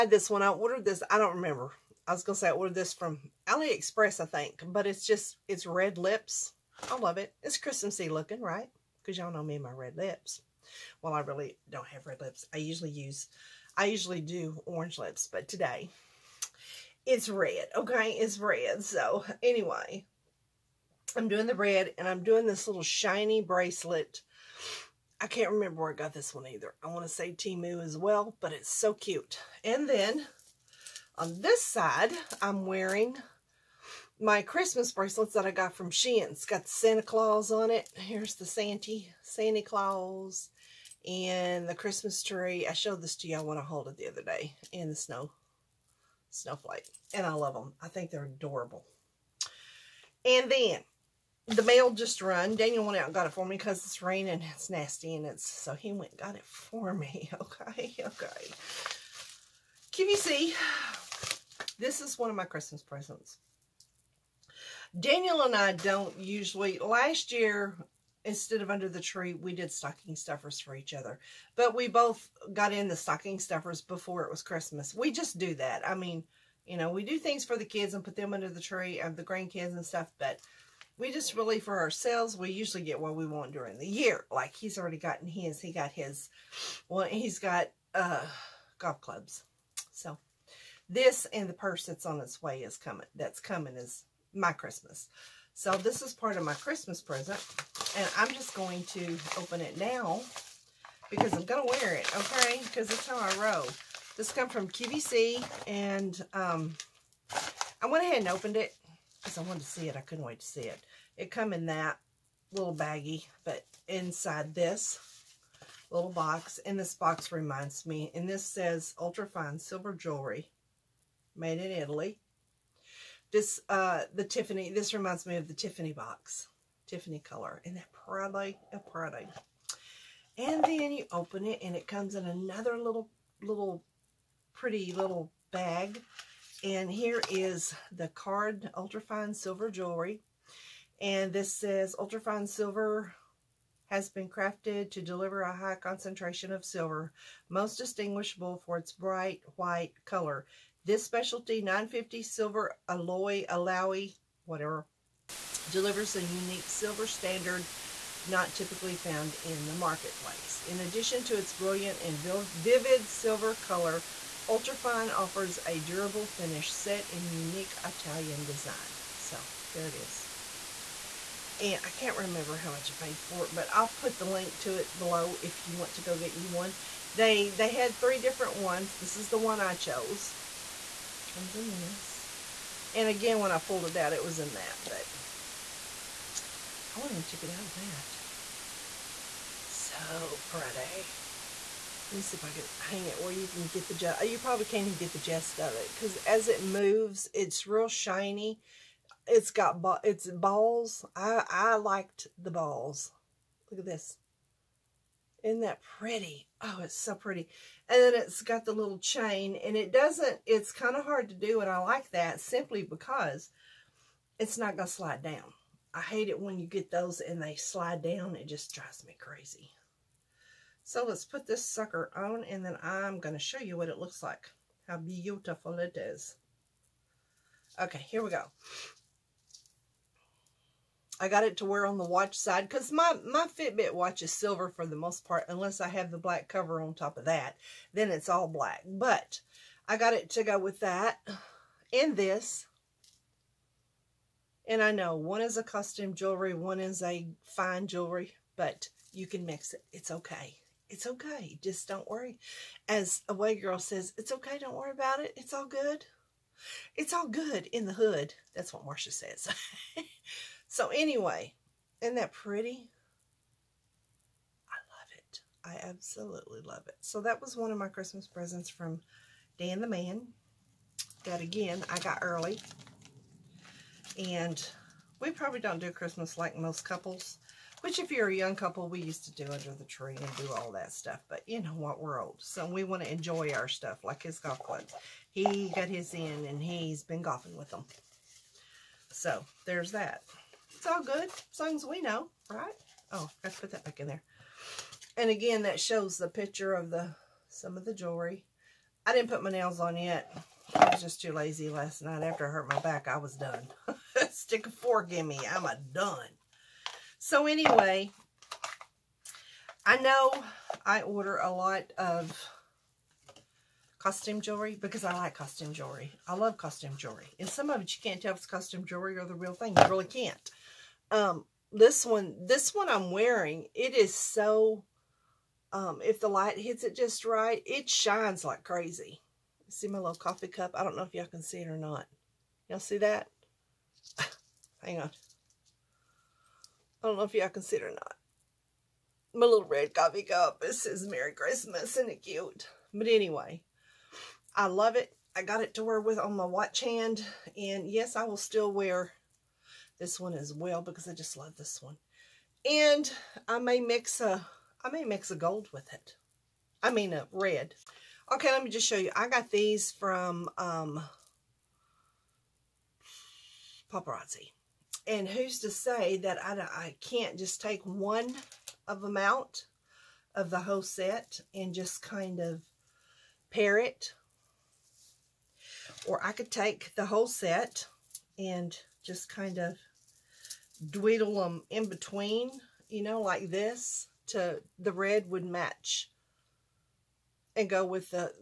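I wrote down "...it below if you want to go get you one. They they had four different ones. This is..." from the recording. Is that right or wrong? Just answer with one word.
wrong.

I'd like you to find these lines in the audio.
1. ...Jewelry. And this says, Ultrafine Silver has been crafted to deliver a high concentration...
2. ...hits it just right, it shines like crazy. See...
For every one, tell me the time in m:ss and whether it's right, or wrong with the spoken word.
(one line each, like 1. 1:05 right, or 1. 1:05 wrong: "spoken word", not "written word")
1. 2:19 right
2. 5:26 right.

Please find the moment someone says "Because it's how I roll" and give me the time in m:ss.
1:42.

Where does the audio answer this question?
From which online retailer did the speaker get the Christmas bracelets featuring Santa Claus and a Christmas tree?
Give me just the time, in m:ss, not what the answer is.
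0:35.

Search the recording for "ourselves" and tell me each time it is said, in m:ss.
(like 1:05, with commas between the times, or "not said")
1:21.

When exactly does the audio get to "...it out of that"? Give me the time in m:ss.
3:07.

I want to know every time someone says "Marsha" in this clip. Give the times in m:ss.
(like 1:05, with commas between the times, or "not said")
4:18.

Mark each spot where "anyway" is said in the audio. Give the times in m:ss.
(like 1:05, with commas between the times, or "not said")
0:19, 4:20, 5:07, 5:43.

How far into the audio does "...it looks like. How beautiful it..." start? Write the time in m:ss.
3:43.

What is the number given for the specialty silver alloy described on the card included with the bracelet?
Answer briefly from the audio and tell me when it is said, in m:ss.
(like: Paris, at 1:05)
950, at 2:31.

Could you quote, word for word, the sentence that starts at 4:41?
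But you know what, we're old.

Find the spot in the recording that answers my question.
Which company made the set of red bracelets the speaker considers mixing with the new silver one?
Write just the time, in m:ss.
6:03.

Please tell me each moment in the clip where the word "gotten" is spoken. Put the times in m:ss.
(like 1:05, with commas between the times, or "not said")
1:24.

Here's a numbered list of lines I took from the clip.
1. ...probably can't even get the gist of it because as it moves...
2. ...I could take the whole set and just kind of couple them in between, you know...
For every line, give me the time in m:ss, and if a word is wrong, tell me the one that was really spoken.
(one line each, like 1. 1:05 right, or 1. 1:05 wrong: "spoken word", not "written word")
1. 3:14 right
2. 6:16 wrong: "dweedle", not "couple".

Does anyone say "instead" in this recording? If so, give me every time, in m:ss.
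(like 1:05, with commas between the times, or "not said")
1:08.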